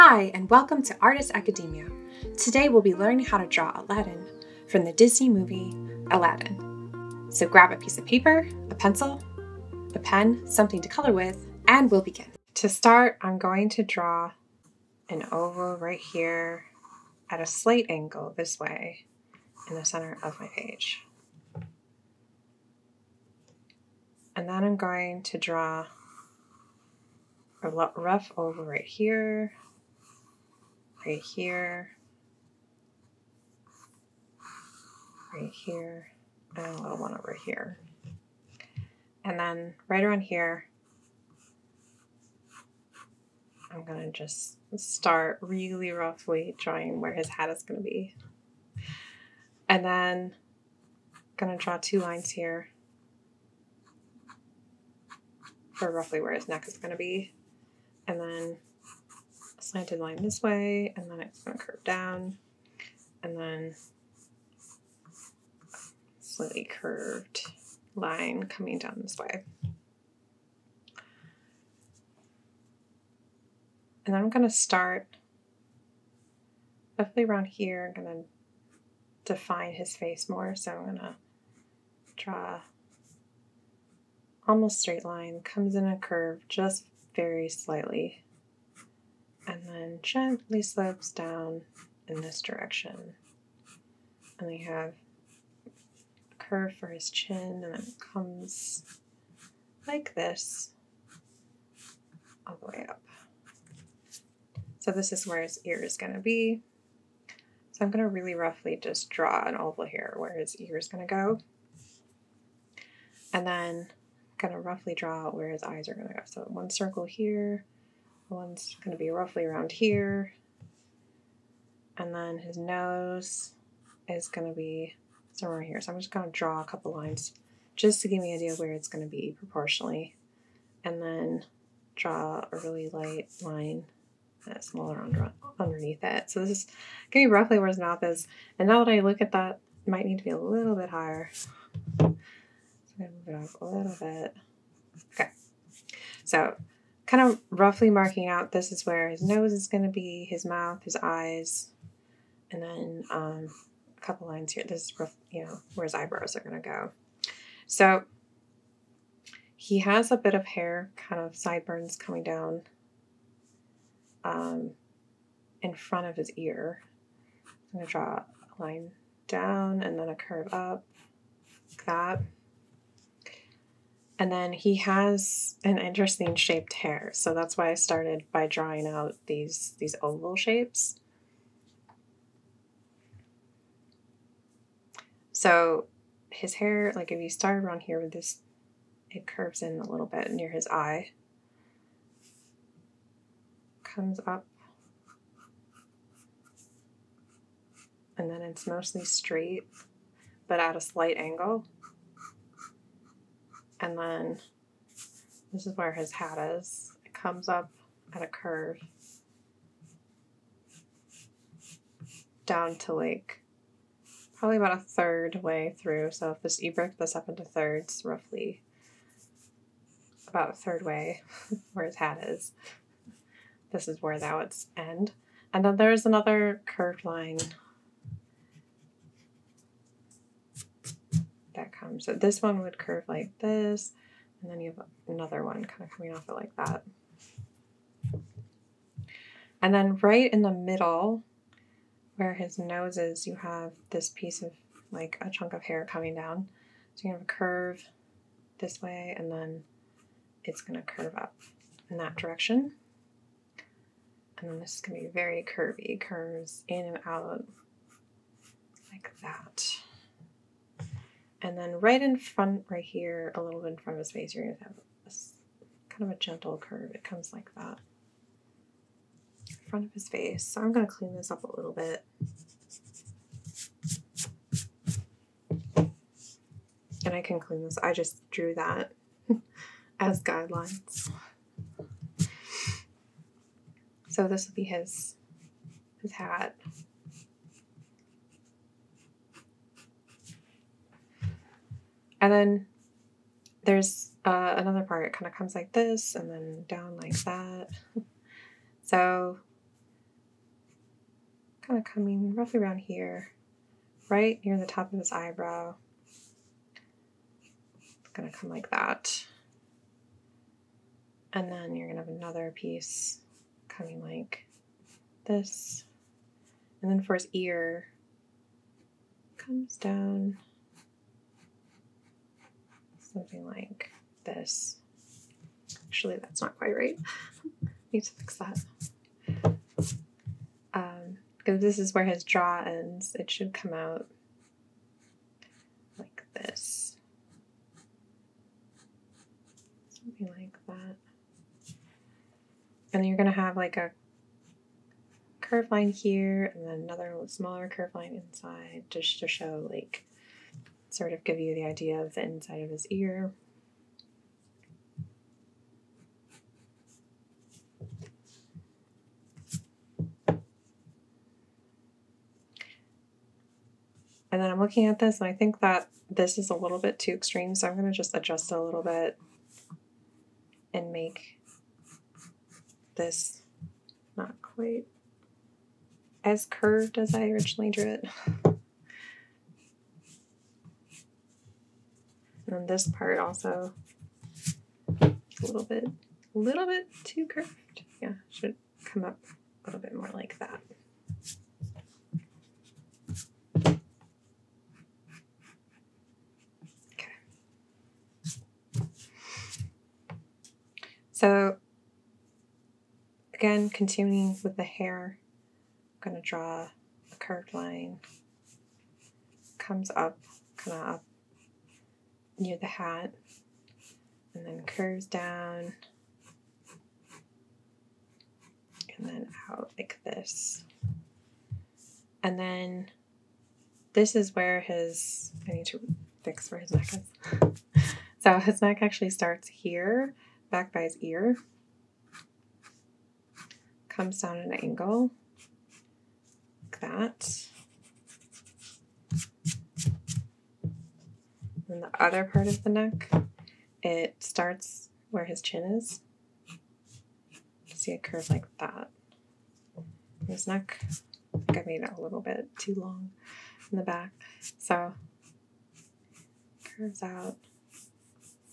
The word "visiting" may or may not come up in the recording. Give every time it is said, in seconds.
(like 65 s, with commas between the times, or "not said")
not said.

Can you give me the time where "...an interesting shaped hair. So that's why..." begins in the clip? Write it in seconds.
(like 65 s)
175 s.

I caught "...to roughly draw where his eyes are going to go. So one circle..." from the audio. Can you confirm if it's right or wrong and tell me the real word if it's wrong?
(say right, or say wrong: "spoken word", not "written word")
right.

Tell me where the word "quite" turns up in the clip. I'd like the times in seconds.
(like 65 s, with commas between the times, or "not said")
326 s, 374 s.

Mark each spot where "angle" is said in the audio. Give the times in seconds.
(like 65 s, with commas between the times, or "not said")
17 s, 201 s, 434 s.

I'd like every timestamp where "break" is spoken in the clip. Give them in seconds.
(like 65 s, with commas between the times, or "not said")
216 s.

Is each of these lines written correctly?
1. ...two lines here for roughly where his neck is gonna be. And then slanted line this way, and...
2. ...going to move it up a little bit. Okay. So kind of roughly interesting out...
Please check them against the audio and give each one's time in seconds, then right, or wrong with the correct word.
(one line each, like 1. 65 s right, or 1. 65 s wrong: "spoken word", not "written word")
1. 51 s right
2. 142 s wrong: "marking", not "interesting".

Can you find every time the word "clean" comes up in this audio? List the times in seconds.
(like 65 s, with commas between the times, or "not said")
270 s, 277 s.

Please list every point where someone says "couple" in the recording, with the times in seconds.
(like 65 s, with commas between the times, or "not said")
126 s, 153 s.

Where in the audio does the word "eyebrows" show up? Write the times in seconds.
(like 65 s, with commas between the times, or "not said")
155 s, 305 s.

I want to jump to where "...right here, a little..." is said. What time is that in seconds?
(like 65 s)
262 s.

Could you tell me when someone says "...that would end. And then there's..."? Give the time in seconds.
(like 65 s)
224 s.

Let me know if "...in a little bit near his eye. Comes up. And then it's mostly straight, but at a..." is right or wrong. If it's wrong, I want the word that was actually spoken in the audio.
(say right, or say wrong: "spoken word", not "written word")
right.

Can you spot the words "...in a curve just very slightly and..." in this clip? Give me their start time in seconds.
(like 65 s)
85 s.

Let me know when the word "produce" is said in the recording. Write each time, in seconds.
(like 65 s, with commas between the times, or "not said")
not said.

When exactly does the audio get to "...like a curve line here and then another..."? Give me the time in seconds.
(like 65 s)
343 s.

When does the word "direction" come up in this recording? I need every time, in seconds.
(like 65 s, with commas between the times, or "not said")
92 s, 252 s.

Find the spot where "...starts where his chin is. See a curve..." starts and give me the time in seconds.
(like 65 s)
444 s.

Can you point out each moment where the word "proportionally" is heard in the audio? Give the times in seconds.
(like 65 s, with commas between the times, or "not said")
129 s.